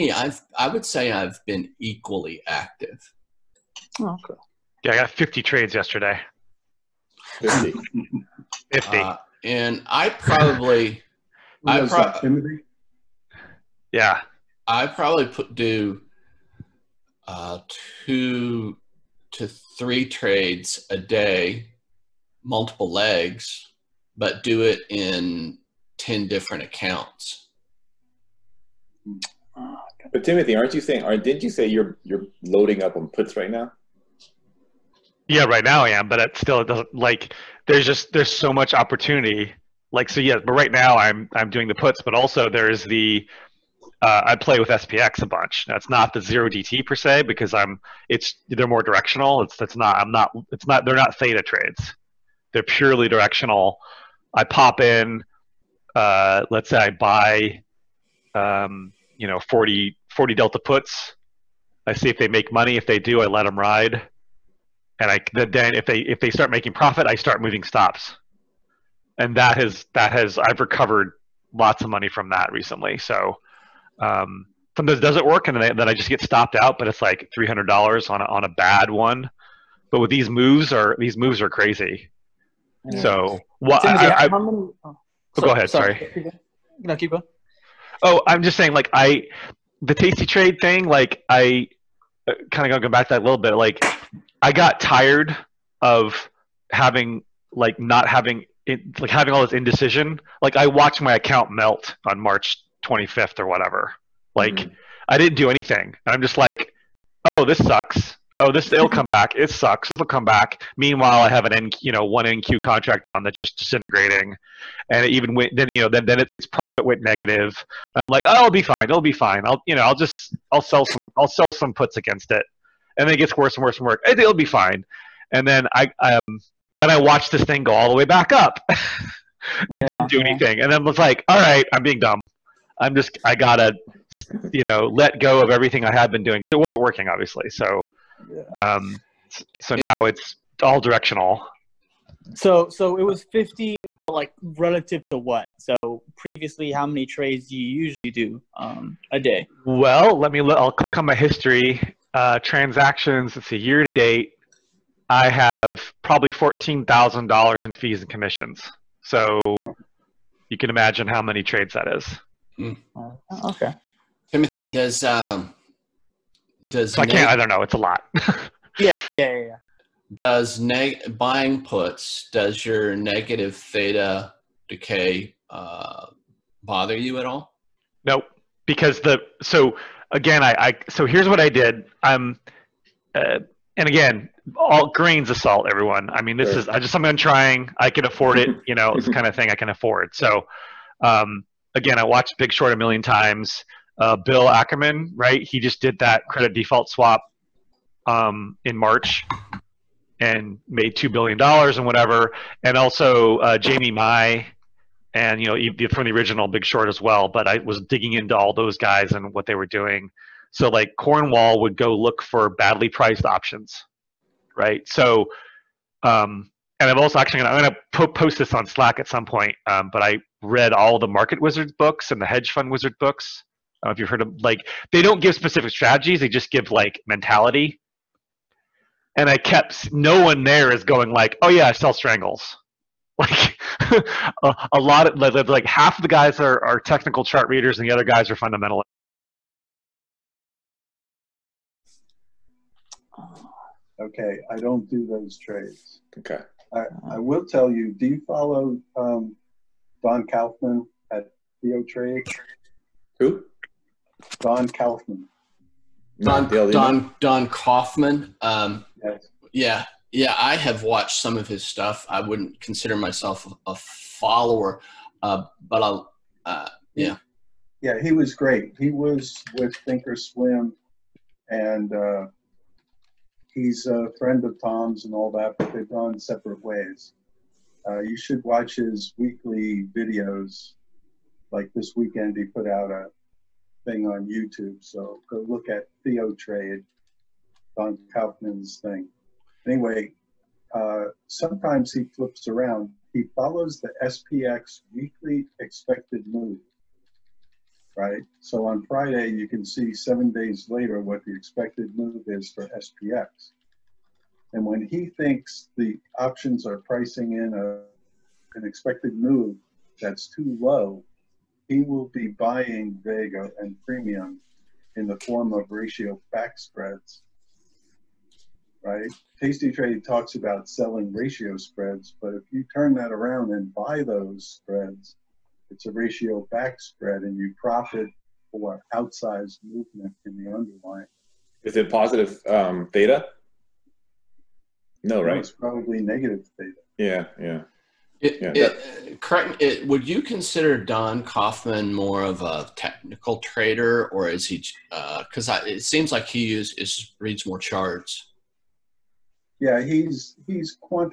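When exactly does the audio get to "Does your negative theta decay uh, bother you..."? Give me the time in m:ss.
2:52.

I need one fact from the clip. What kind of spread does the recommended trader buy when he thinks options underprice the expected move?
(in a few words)
ratio back spreads.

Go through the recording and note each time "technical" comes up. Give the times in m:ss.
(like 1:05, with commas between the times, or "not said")
3:56, 5:42.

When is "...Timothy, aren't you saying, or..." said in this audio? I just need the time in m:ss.
0:30.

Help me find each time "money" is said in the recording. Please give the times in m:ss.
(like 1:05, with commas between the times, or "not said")
1:02, 1:11.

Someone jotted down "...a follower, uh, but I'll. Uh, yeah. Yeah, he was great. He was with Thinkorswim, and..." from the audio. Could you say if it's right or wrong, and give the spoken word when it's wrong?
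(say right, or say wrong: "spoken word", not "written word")
right.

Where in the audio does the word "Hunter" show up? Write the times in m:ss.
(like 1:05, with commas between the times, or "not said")
not said.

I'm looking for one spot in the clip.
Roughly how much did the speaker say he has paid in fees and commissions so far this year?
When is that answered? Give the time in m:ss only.
2:36.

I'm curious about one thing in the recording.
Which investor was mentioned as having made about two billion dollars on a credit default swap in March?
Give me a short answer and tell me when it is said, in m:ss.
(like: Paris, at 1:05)
Bill Ackerman, at 3:14.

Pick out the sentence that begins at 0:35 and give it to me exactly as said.
Yeah, right now I am, but it still it doesn't like there's just there's so much opportunity.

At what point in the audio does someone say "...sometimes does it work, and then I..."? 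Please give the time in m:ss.
1:14.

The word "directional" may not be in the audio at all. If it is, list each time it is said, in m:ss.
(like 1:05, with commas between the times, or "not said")
0:48, 0:53, 2:20.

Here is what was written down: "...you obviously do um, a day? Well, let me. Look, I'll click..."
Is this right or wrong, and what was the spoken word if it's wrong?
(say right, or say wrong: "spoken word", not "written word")
wrong: "usually", not "obviously".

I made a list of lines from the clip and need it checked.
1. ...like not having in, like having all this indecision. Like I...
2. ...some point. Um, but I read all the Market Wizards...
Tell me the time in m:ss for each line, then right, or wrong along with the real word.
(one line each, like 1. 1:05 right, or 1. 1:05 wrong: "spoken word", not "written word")
1. 1:37 right
2. 3:39 right.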